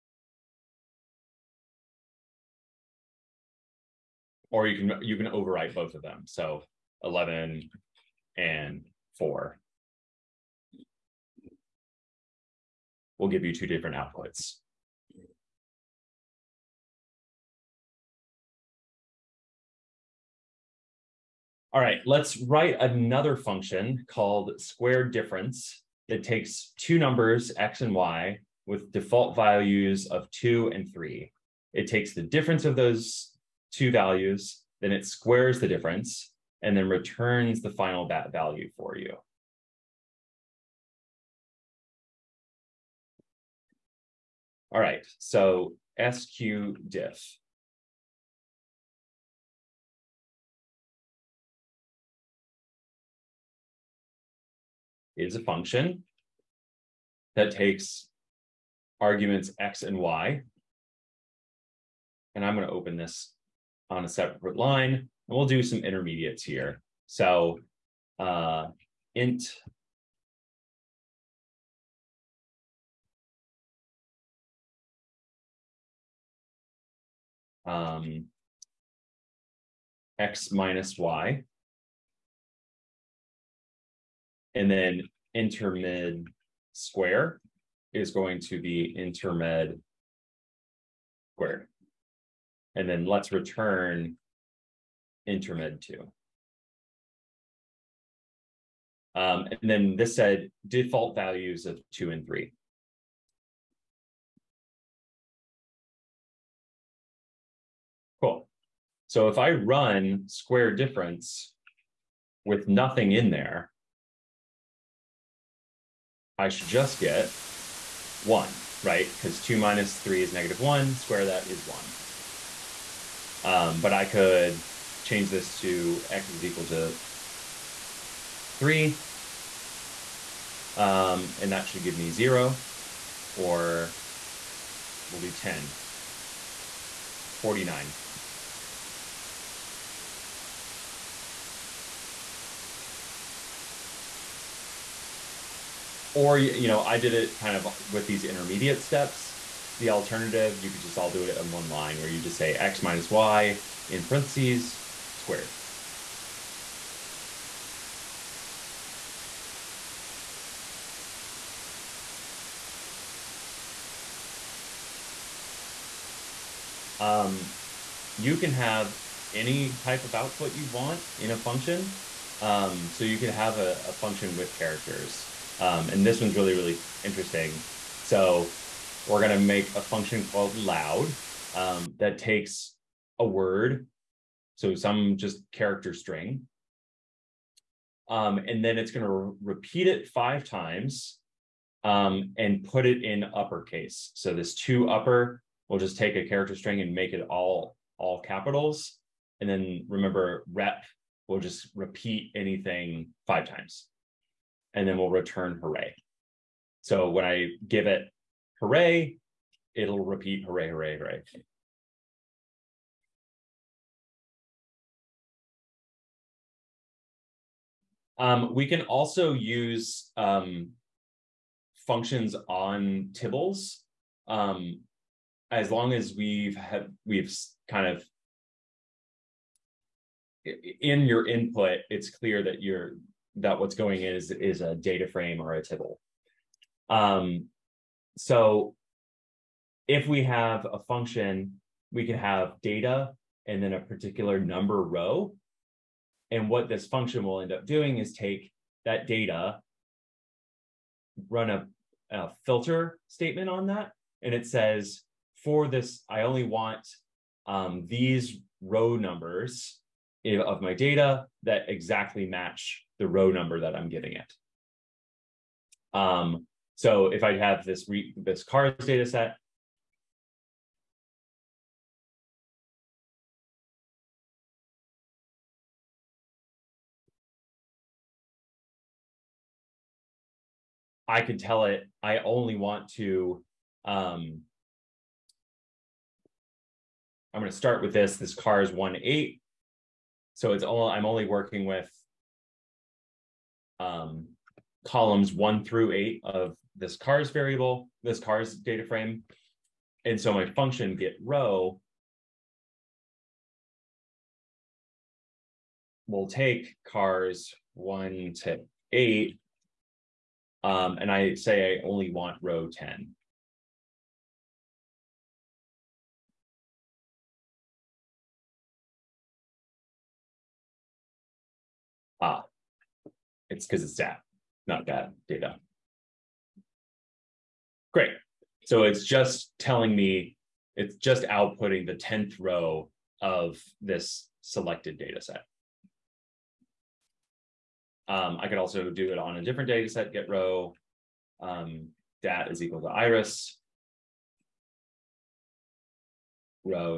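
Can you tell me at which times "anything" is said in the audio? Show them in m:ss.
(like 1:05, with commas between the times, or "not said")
3:22.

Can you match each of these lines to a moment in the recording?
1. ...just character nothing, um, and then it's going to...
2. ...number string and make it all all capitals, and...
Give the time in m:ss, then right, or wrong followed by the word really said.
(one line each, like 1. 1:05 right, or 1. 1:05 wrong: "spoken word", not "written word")
1. 3:05 wrong: "string", not "nothing"
2. 3:16 wrong: "character", not "number".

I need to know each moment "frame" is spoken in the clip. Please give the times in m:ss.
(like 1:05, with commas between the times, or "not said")
3:55, 4:58.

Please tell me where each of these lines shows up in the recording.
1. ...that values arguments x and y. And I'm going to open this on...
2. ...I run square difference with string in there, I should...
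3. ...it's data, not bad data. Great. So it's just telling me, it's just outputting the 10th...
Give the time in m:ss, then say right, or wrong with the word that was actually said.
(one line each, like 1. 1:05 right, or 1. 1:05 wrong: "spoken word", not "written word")
1. 0:57 wrong: "takes", not "values"
2. 1:49 wrong: "nothing", not "string"
3. 5:23 right.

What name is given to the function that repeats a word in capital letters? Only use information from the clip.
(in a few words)
loud.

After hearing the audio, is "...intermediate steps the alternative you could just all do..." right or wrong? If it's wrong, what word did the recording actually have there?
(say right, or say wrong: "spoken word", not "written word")
right.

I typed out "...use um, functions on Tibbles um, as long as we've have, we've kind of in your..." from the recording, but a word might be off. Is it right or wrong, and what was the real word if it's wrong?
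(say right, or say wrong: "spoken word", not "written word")
right.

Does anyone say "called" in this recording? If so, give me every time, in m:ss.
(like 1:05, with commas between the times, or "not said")
0:24, 3:00.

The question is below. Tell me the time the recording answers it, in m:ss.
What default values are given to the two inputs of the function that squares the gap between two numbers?
0:28.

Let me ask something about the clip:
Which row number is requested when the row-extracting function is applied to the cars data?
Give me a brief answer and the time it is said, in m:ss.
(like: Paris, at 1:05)
10, at 5:12.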